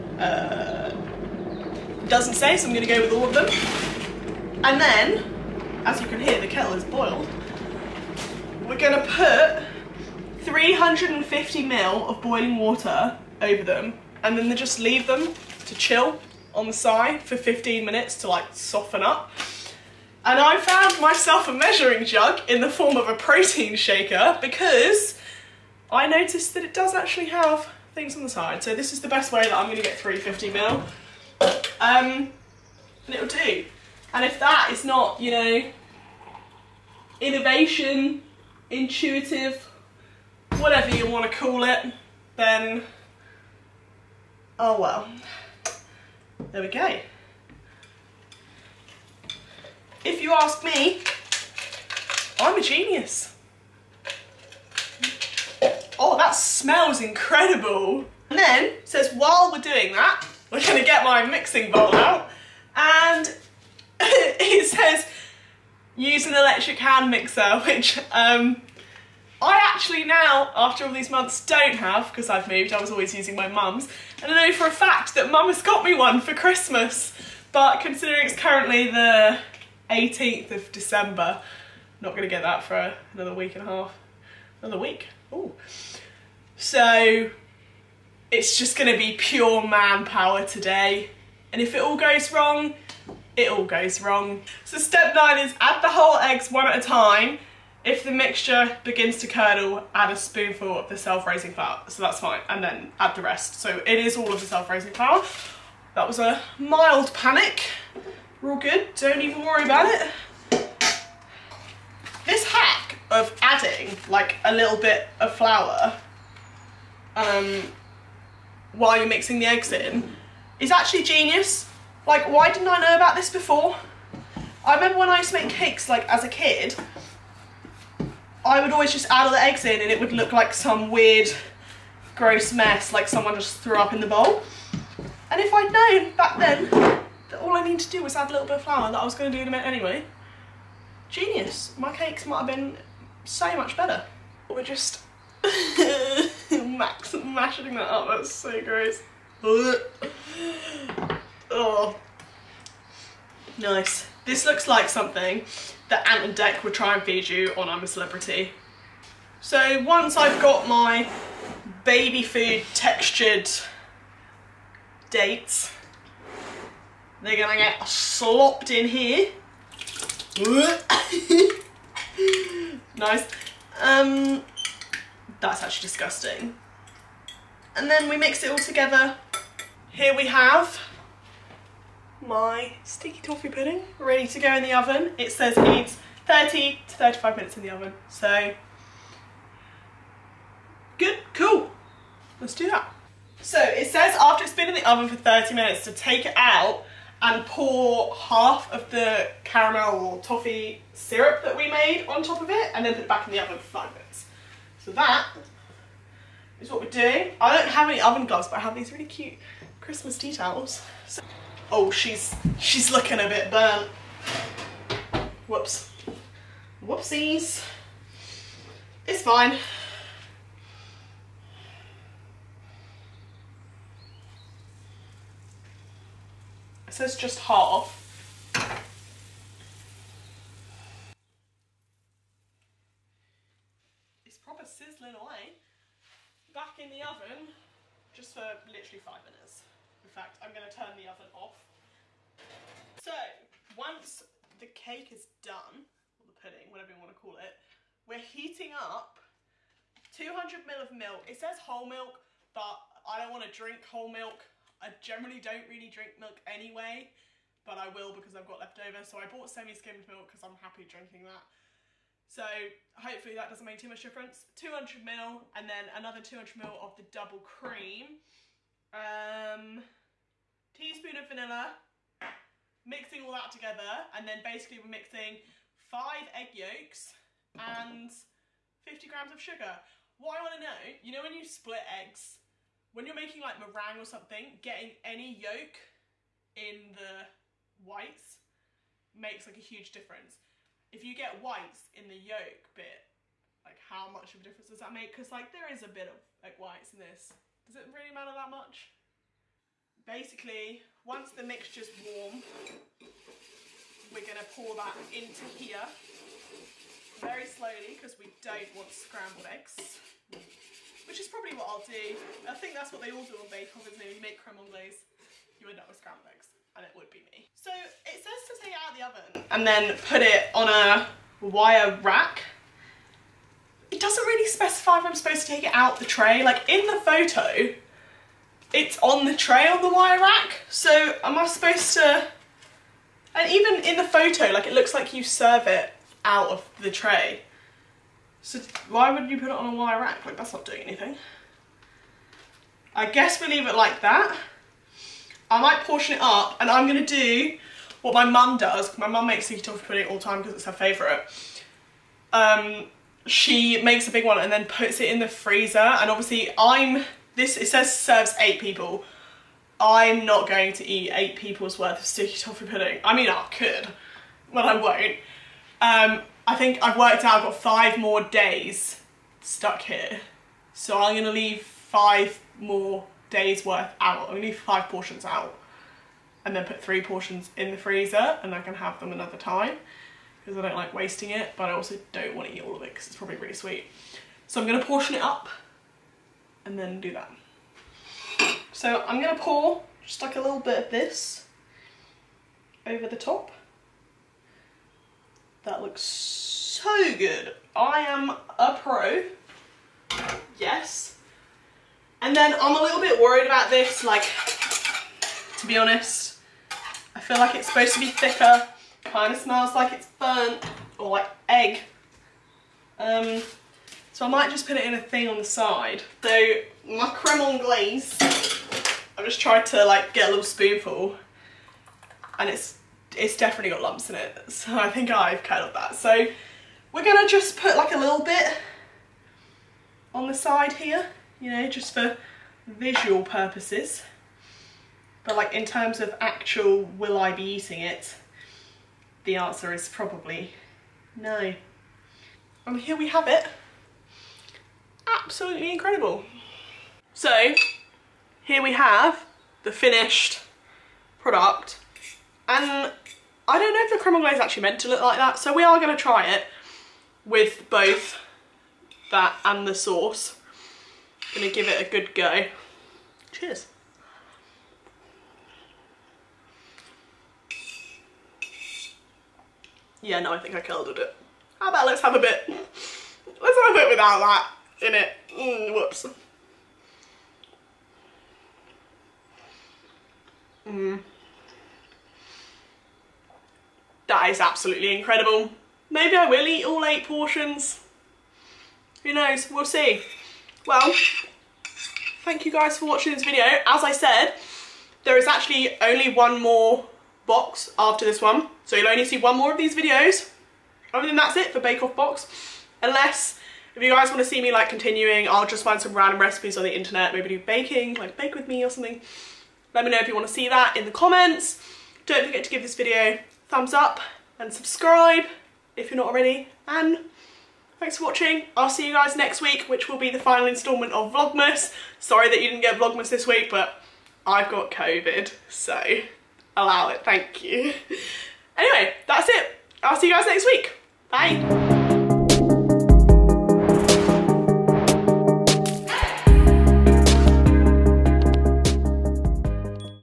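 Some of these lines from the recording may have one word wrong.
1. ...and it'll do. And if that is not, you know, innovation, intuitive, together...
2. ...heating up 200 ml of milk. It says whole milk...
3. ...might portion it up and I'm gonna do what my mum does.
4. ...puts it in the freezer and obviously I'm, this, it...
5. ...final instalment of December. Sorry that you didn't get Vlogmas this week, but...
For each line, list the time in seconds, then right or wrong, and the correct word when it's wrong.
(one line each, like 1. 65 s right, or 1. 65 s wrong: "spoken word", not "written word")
1. 33 s wrong: "whatever", not "together"
2. 248 s right
3. 345 s right
4. 354 s right
5. 520 s wrong: "Vlogmas", not "December".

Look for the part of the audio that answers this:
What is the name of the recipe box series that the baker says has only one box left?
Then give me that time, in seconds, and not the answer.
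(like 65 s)
501 s.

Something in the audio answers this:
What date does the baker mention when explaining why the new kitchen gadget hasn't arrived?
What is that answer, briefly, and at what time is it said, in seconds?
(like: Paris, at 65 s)
18th of December, at 79 s.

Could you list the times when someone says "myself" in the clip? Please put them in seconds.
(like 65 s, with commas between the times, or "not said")
21 s.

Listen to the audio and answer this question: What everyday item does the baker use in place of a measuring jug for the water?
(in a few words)
protein shaker.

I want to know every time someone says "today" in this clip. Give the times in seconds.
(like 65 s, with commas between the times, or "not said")
90 s.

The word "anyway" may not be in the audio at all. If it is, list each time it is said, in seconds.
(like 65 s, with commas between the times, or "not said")
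139 s, 256 s, 528 s.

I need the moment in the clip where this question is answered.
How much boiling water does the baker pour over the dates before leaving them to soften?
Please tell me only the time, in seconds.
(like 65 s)
10 s.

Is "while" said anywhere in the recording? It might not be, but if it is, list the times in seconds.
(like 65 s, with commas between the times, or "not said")
59 s, 118 s.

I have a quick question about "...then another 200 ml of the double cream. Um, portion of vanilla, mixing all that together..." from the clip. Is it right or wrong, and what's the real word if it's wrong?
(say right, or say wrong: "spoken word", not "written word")
wrong: "teaspoon", not "portion".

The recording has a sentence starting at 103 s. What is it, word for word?
So it is all of the self-raising flour.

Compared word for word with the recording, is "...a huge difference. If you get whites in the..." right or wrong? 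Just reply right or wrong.
right.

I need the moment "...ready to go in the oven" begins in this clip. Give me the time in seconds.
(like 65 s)
183 s.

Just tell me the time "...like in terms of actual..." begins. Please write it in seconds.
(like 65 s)
435 s.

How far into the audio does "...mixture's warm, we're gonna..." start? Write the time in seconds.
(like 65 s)
301 s.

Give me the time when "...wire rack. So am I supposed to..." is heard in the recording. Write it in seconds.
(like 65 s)
329 s.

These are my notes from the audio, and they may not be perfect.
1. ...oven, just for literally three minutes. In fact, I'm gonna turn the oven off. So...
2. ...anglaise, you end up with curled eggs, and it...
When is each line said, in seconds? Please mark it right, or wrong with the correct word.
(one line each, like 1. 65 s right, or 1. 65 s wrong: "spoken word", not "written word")
1. 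237 s wrong: "five", not "three"
2. 314 s wrong: "scrambled", not "curled".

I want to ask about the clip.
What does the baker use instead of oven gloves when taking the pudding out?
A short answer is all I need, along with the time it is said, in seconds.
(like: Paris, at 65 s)
Christmas tea towels, at 209 s.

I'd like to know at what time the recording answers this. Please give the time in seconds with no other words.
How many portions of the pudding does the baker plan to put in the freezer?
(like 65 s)
376 s.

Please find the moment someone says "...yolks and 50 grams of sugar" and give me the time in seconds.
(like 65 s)
276 s.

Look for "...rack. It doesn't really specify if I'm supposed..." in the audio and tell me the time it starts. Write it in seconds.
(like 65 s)
322 s.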